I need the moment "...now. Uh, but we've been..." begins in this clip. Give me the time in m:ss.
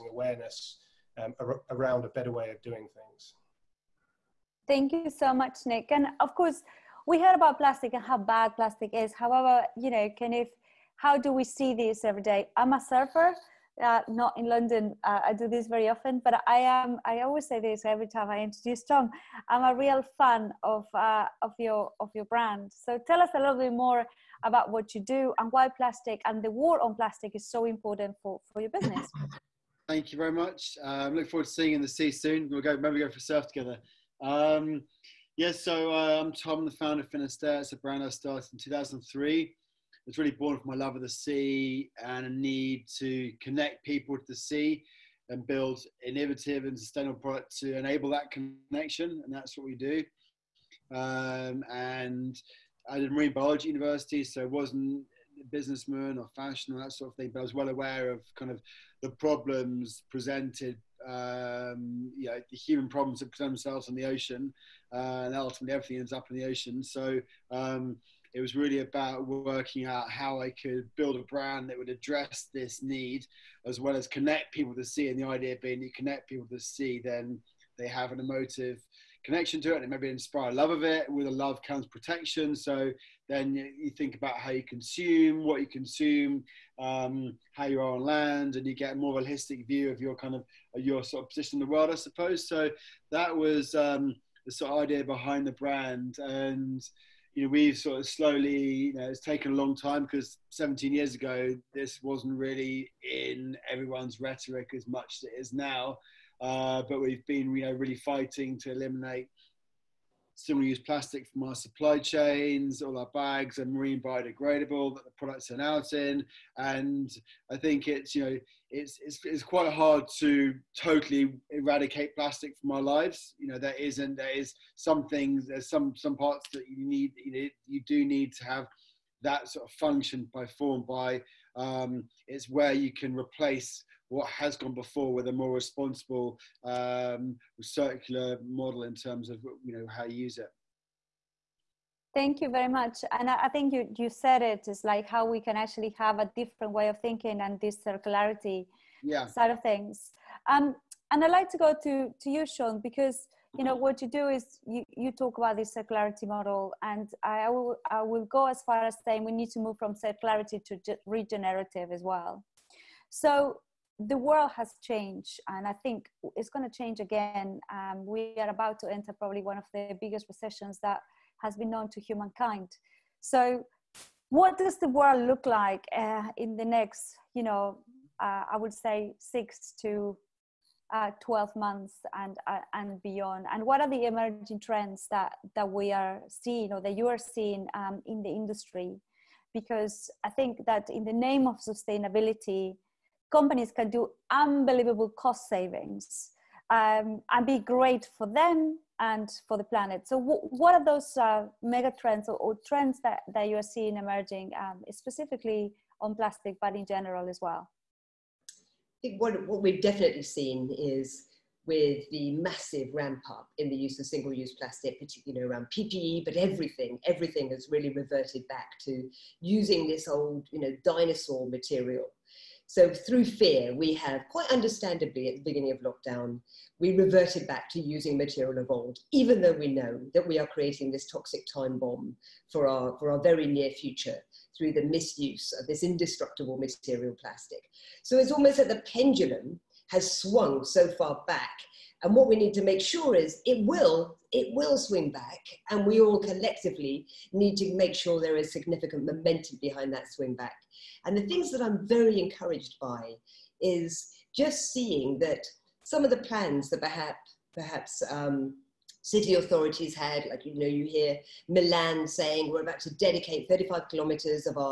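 1:45.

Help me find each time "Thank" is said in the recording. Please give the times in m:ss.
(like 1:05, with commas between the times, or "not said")
0:04, 0:29, 2:22.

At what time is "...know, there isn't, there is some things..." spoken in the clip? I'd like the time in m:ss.
2:03.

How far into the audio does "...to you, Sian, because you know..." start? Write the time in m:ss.
2:32.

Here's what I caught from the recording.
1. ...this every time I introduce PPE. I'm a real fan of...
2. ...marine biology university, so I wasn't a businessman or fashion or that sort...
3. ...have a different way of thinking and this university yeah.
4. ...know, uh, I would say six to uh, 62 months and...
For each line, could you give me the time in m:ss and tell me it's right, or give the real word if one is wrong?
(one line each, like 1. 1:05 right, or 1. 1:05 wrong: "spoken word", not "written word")
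1. 0:17 wrong: "Tom", not "PPE"
2. 0:53 right
3. 2:25 wrong: "circularity", not "university"
4. 2:57 wrong: "12", not "62".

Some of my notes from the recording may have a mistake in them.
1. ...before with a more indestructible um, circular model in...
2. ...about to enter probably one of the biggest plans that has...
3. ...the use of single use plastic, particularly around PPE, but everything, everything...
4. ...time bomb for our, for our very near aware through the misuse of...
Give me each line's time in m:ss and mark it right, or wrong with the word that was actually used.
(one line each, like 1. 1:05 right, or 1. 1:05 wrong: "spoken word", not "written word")
1. 2:14 wrong: "responsible", not "indestructible"
2. 2:48 wrong: "recessions", not "plans"
3. 3:33 right
4. 3:51 wrong: "future", not "aware".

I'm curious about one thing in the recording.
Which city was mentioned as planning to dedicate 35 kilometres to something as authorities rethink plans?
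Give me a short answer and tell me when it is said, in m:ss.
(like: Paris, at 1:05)
Milan, at 4:21.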